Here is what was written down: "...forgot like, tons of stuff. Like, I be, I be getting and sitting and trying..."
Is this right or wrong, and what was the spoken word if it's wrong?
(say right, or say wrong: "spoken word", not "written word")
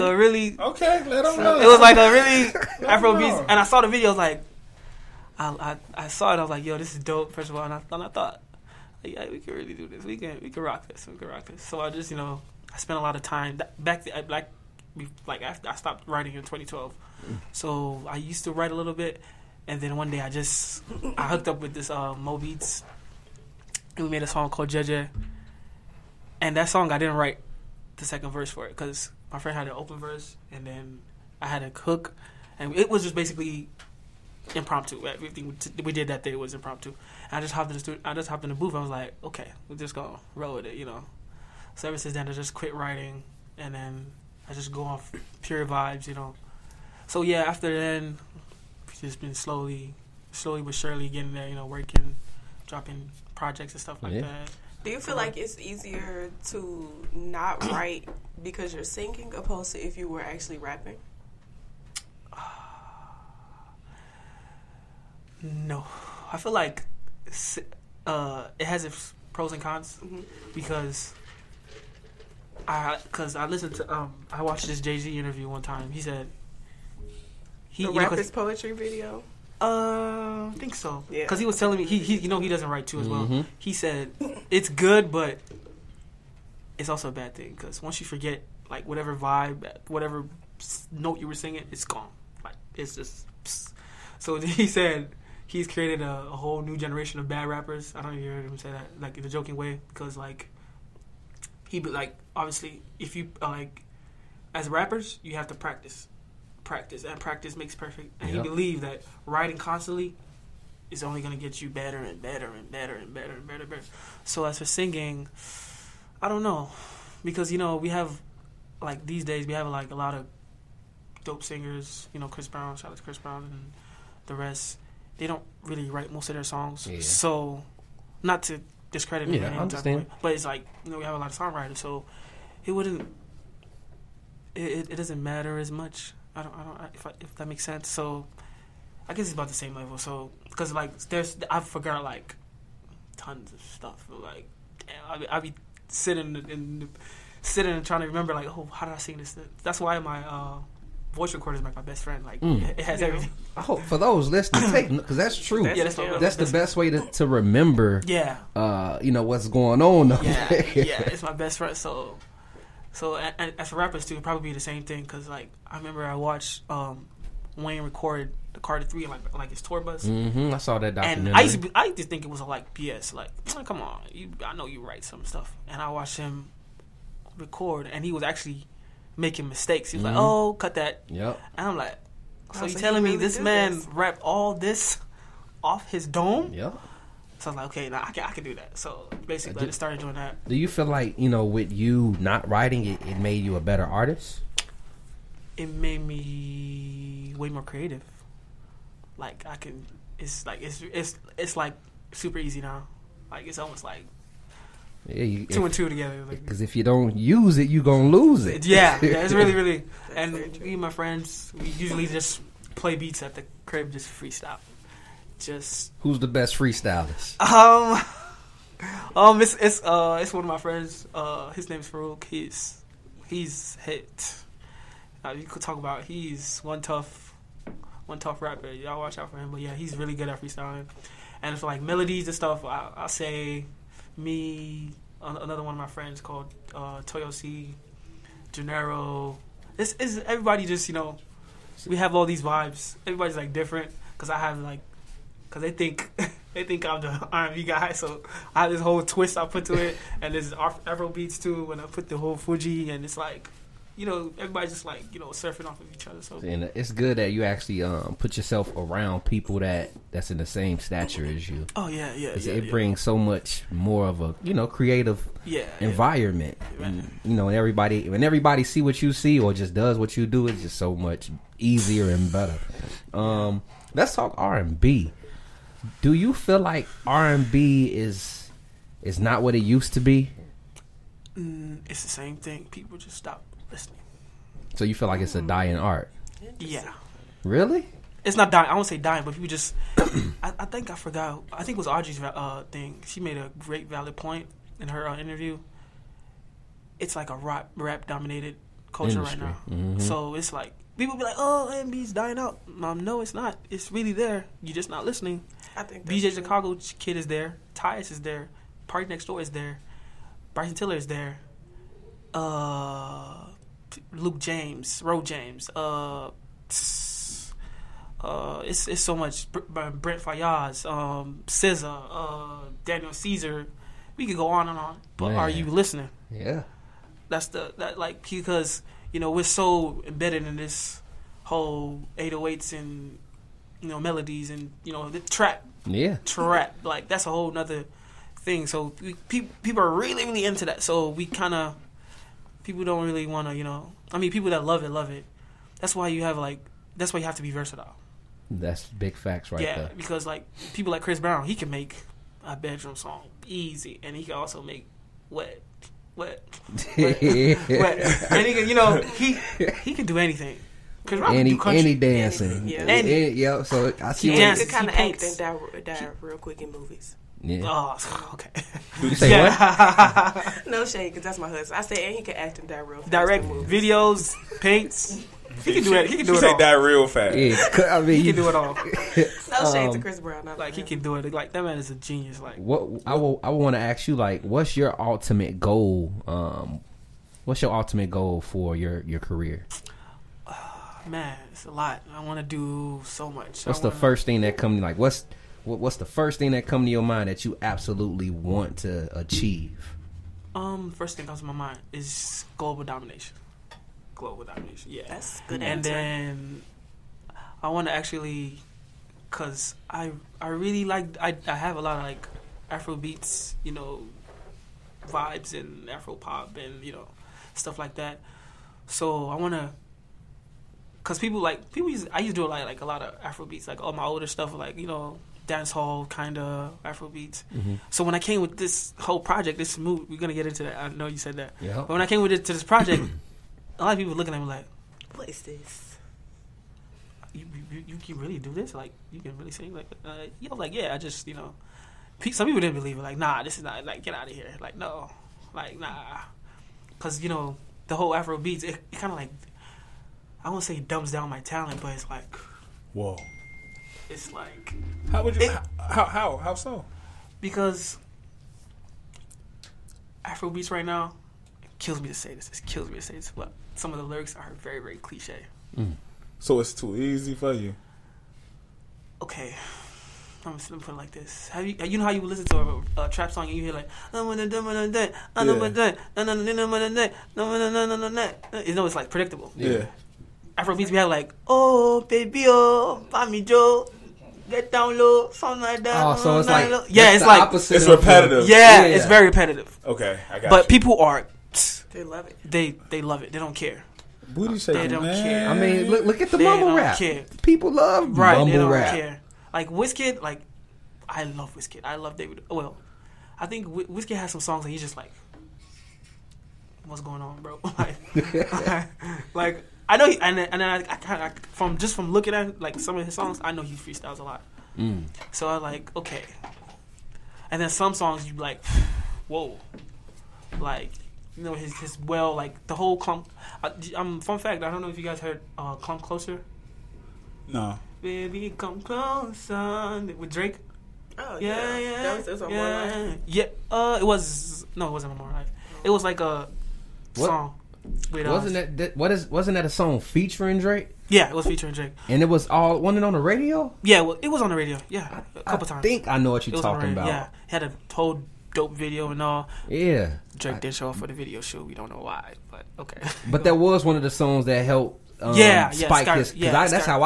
wrong: "sitting", not "getting".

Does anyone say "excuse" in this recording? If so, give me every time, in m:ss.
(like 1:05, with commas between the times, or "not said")
not said.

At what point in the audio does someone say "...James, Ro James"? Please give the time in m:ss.
5:14.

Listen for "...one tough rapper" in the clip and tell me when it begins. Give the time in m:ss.
3:48.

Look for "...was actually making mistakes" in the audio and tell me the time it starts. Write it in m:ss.
2:58.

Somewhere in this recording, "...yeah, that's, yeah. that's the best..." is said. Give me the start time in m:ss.
2:35.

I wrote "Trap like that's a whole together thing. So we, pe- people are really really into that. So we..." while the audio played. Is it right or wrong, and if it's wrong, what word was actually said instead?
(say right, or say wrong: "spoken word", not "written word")
wrong: "nother", not "together".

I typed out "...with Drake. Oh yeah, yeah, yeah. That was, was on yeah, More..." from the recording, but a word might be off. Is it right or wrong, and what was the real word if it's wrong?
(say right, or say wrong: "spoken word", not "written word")
right.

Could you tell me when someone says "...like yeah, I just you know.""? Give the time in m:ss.
7:20.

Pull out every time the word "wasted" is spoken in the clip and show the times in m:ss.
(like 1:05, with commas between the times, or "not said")
not said.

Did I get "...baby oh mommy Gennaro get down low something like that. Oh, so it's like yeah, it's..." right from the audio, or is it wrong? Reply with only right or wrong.
wrong.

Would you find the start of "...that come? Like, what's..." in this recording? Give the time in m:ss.
6:34.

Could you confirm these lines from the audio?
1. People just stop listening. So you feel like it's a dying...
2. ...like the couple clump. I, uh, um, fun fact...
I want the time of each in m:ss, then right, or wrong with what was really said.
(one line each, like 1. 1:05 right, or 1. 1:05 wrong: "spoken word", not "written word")
1. 4:42 right
2. 8:42 wrong: "whole", not "couple".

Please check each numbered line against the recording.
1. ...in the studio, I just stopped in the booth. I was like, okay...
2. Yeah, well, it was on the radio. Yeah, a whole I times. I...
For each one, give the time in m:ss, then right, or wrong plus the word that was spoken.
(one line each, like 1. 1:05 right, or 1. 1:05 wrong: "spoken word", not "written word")
1. 0:37 wrong: "hopped", not "stopped"
2. 9:03 wrong: "couple", not "whole".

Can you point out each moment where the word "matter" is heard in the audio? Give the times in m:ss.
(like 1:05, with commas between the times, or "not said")
2:15.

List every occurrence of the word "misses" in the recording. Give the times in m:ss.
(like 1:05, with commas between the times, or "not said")
not said.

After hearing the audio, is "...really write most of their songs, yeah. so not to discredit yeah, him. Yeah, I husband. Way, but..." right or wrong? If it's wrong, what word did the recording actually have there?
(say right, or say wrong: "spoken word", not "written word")
wrong: "understand", not "husband".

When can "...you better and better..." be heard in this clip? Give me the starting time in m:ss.
1:51.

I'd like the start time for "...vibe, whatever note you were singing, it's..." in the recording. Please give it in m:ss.
1:29.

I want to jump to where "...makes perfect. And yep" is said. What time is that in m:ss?
1:47.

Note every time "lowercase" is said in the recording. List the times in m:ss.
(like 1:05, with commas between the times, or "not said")
not said.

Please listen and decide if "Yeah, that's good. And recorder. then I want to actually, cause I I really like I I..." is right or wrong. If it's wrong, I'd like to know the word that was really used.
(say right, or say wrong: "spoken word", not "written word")
wrong: "answer", not "recorder".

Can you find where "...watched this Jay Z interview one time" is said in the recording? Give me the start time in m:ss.
1:14.